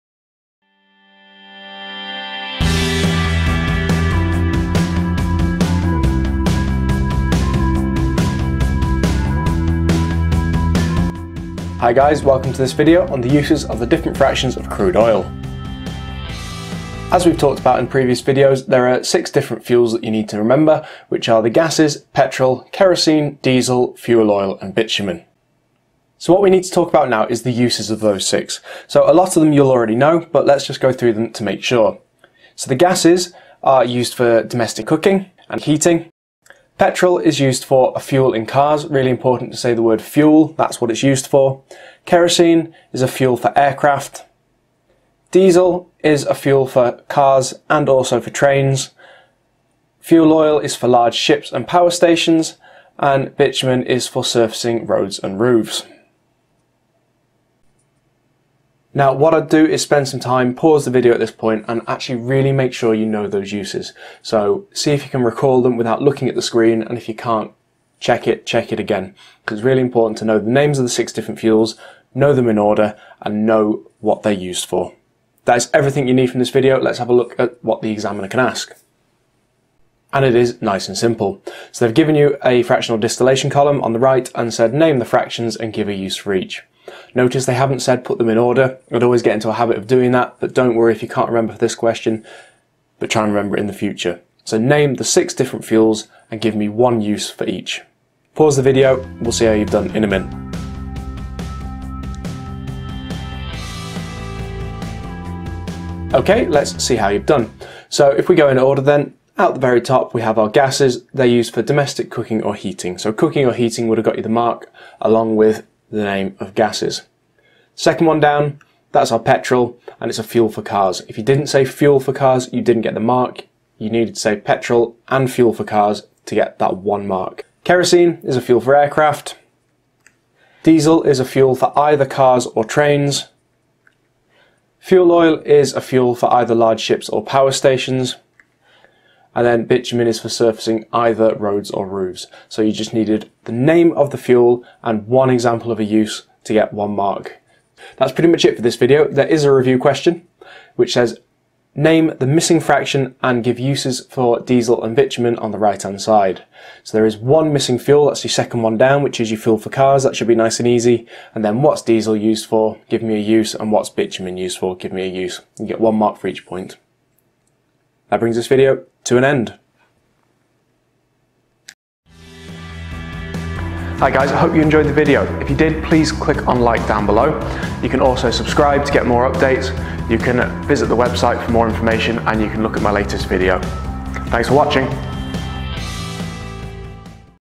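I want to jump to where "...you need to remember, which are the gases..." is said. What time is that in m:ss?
0:20.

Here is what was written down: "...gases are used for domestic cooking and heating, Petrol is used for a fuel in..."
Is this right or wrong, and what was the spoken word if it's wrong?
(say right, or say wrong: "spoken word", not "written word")
right.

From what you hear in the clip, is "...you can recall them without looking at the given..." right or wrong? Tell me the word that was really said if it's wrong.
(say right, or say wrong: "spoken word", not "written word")
wrong: "screen", not "given".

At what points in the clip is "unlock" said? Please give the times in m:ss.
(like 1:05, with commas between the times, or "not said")
not said.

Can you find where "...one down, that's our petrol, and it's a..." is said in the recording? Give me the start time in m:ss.
1:58.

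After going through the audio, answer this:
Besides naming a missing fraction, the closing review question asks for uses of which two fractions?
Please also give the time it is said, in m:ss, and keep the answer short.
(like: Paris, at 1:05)
Diesel and bitumen, at 2:34.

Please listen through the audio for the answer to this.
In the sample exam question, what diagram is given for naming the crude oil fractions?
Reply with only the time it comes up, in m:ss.
1:22.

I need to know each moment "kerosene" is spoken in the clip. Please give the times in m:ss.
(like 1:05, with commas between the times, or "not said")
0:22, 0:42, 2:07.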